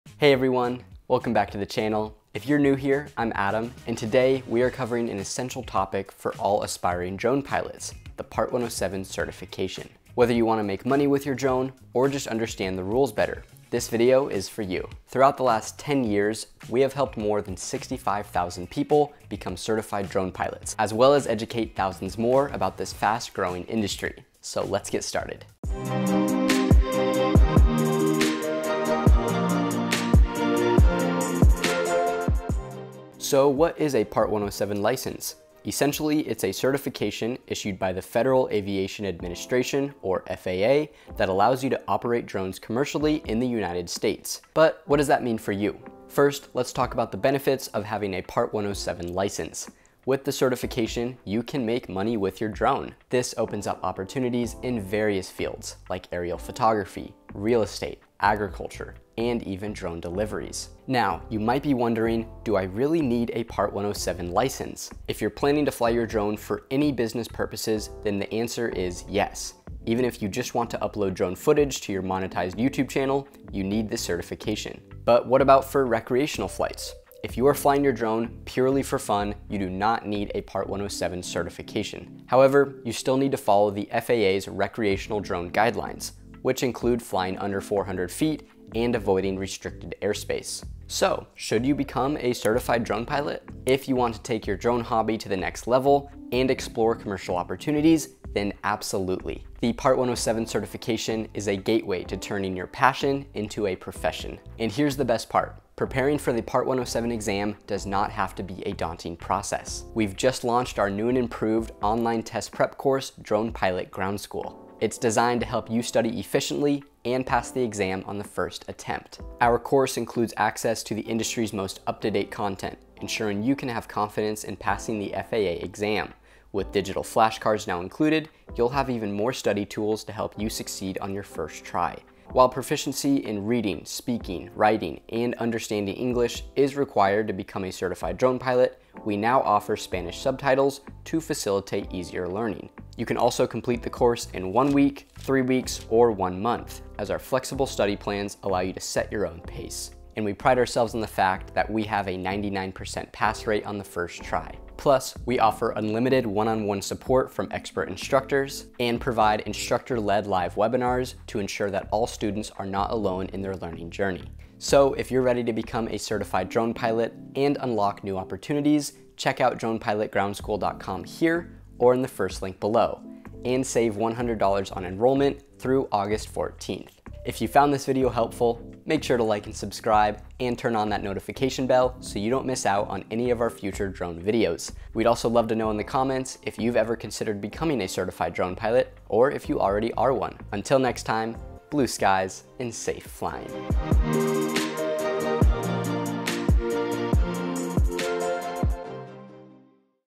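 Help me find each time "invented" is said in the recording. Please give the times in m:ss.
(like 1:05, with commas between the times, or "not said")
not said.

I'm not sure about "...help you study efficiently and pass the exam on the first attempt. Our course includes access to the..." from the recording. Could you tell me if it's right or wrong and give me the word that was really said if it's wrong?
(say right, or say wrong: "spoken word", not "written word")
right.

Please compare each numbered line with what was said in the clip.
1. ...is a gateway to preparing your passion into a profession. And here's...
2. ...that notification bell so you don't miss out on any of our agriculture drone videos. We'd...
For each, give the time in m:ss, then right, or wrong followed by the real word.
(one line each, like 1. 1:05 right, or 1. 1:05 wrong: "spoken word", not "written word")
1. 1:41 wrong: "turning", not "preparing"
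2. 3:00 wrong: "future", not "agriculture".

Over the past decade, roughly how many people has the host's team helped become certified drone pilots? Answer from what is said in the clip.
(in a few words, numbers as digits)
65,000.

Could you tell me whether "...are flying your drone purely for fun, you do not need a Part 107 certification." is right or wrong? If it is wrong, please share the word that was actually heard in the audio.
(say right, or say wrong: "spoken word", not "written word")
right.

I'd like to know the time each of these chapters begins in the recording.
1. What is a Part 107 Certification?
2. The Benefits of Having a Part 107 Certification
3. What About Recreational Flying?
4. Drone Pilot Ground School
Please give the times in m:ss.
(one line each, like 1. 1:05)
1. 0:33
2. 0:45
3. 1:14
4. 1:44.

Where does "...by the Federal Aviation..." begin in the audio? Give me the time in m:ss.
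0:37.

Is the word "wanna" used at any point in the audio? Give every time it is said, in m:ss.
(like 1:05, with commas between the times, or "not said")
0:10.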